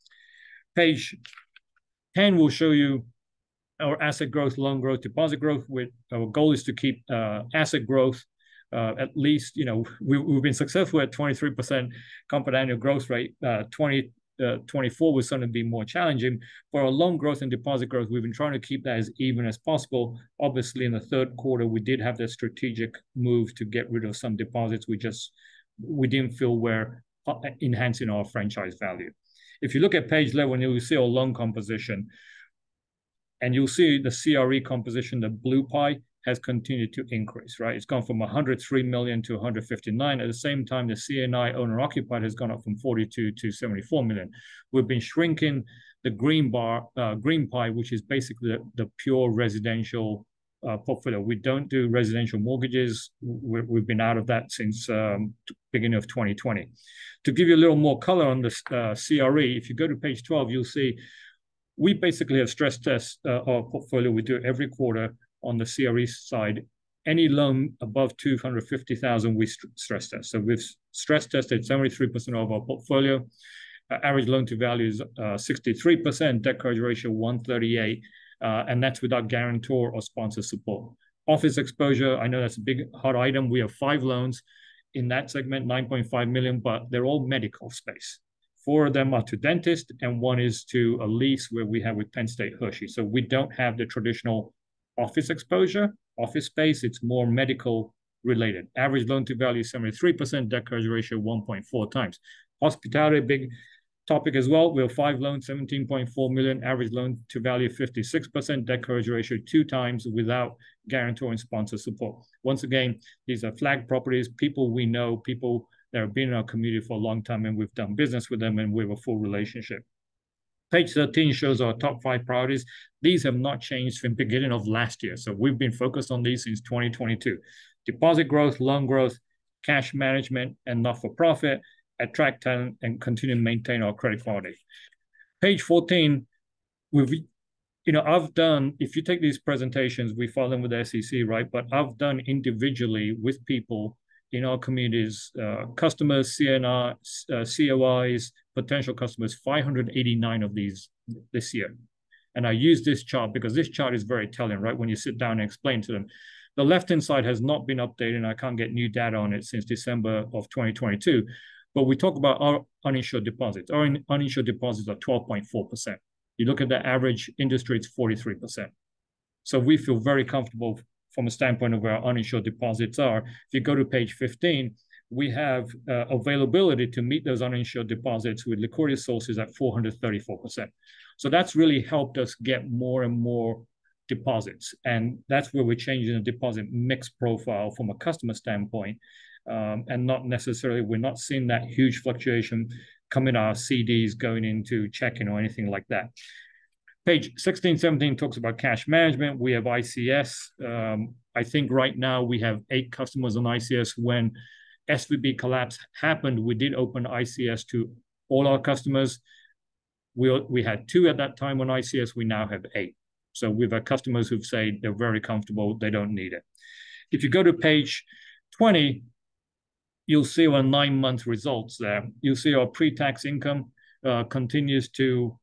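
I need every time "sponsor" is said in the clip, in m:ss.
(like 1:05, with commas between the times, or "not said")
1:20, 1:51.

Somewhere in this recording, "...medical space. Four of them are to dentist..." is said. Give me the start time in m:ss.
1:27.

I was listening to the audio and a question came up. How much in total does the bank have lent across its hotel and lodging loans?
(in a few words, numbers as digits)
$17.4 million.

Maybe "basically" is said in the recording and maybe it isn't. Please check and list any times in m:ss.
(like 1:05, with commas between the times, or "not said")
0:48, 1:01.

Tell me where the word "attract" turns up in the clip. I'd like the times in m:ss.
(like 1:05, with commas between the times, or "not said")
2:11.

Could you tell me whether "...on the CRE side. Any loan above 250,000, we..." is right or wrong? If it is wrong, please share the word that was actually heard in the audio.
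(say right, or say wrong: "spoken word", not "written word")
right.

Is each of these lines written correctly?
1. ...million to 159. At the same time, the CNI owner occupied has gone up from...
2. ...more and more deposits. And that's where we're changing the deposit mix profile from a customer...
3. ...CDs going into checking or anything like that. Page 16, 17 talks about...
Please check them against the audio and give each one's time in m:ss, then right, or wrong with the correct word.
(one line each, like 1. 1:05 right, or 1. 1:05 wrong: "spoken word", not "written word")
1. 0:38 right
2. 3:02 right
3. 3:13 right.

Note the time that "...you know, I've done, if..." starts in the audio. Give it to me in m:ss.
2:17.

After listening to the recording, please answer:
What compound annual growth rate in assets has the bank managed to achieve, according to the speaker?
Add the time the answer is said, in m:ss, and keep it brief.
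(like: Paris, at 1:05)
23%, at 0:11.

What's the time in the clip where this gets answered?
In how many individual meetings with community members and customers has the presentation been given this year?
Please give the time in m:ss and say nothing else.
2:29.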